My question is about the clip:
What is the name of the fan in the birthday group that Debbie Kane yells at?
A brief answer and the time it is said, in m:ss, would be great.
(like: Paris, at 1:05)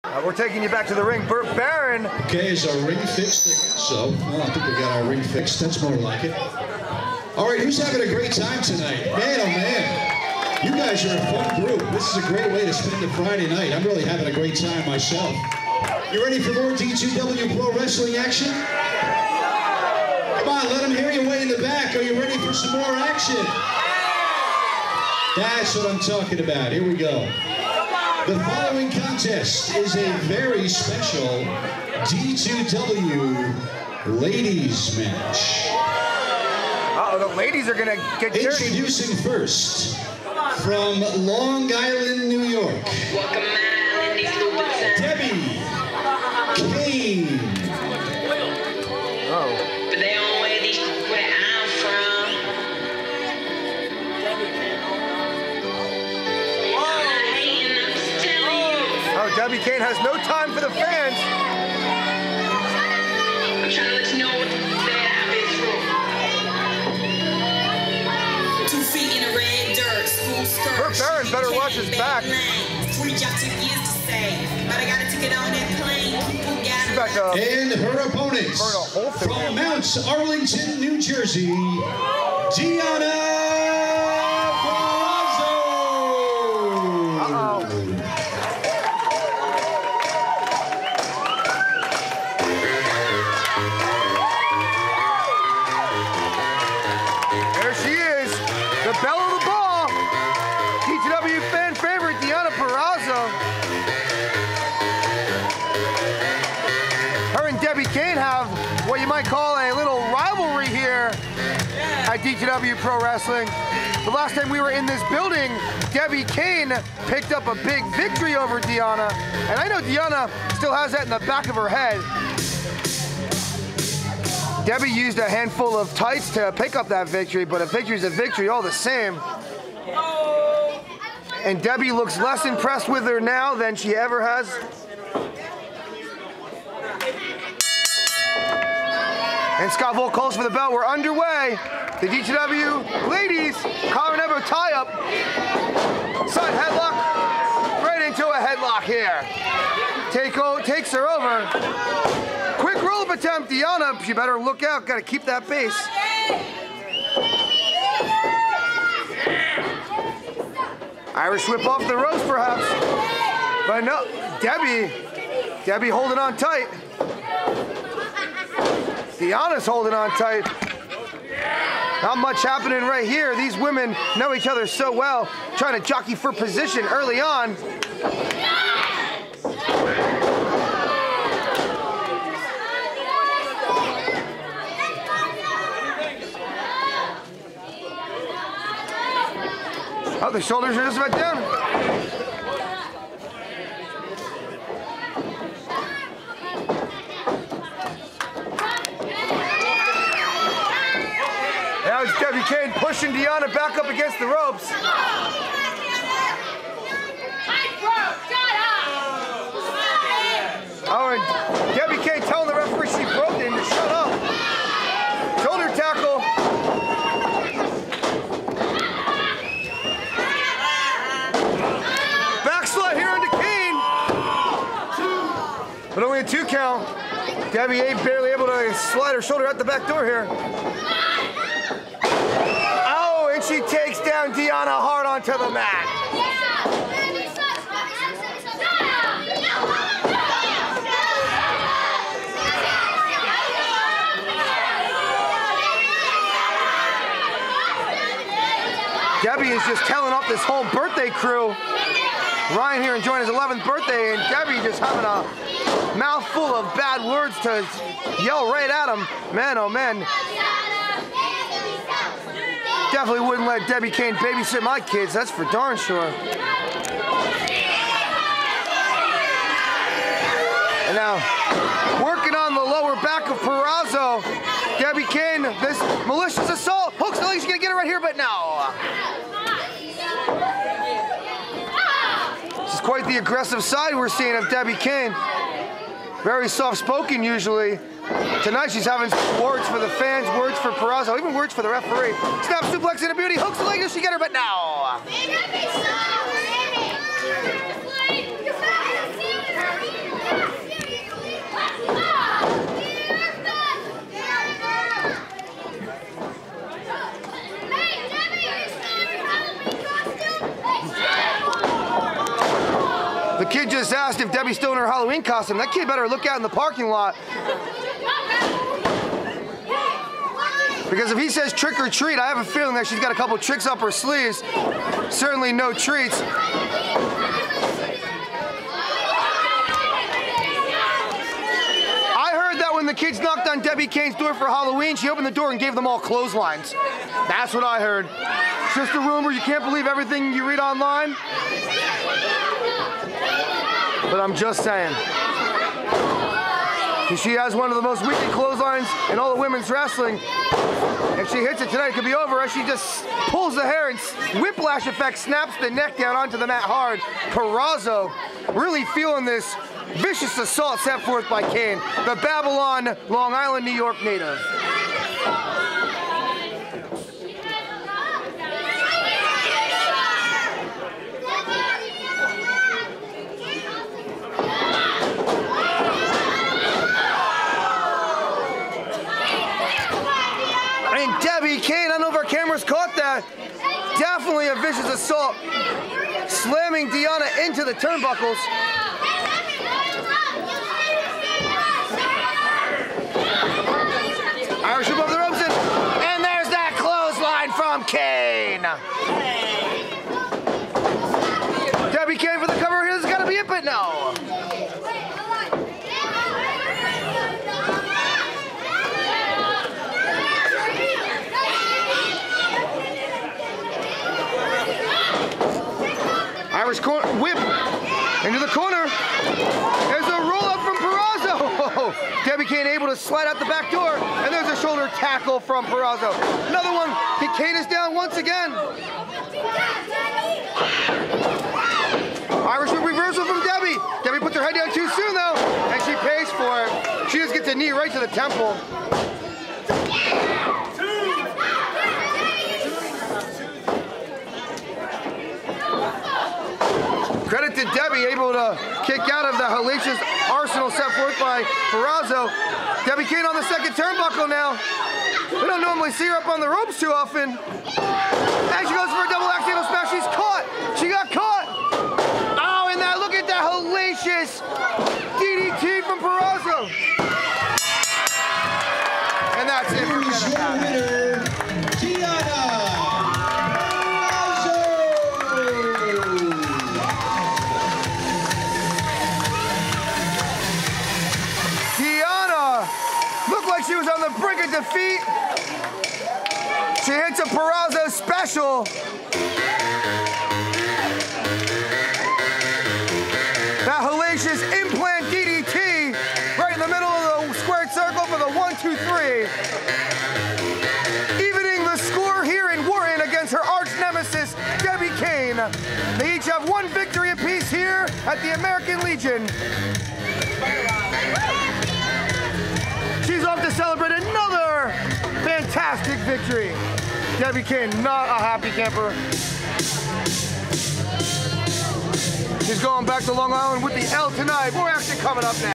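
Ryan, at 4:12.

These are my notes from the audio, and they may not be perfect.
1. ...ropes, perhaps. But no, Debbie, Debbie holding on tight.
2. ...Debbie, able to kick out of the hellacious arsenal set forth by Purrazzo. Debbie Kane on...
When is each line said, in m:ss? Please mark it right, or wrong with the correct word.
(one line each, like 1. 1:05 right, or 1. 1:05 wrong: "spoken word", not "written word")
1. 2:41 right
2. 7:27 right.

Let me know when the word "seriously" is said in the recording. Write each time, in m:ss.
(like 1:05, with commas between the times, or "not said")
not said.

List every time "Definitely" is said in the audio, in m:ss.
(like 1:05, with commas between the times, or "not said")
4:22, 6:23.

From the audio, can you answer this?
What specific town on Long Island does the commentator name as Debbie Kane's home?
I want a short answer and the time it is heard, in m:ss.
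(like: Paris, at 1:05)
Babylon, at 6:02.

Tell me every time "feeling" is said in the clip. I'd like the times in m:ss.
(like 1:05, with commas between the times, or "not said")
5:22, 5:58.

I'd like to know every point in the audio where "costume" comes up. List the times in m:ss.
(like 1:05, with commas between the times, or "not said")
5:15.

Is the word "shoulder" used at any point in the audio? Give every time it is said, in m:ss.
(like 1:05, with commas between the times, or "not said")
3:10, 3:35, 3:49, 7:04.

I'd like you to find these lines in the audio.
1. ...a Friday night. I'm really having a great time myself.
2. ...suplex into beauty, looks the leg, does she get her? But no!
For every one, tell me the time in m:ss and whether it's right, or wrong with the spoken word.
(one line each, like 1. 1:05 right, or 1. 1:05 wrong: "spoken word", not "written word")
1. 0:13 right
2. 4:52 wrong: "hooks", not "looks".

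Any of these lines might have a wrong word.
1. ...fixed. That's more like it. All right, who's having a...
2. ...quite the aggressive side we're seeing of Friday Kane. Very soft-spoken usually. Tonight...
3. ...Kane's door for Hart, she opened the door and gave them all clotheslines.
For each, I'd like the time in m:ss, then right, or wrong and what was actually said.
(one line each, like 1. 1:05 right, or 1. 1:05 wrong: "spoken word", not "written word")
1. 0:05 right
2. 4:42 wrong: "Debbie", not "Friday"
3. 5:33 wrong: "Halloween", not "Hart".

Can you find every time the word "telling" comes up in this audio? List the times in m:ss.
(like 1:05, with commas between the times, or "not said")
3:32, 4:09.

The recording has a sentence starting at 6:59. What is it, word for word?
There's a roll up from Purrazzo.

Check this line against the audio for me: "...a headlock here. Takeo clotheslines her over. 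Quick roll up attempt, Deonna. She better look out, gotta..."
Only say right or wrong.
wrong.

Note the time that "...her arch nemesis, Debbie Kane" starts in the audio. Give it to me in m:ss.
8:23.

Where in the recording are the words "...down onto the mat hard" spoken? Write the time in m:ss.
5:55.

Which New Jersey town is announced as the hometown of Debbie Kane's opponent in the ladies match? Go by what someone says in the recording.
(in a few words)
Mount Arlington.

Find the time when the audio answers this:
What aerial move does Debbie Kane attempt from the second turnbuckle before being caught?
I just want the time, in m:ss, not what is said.
7:39.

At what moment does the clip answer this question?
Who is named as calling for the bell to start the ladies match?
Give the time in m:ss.
2:19.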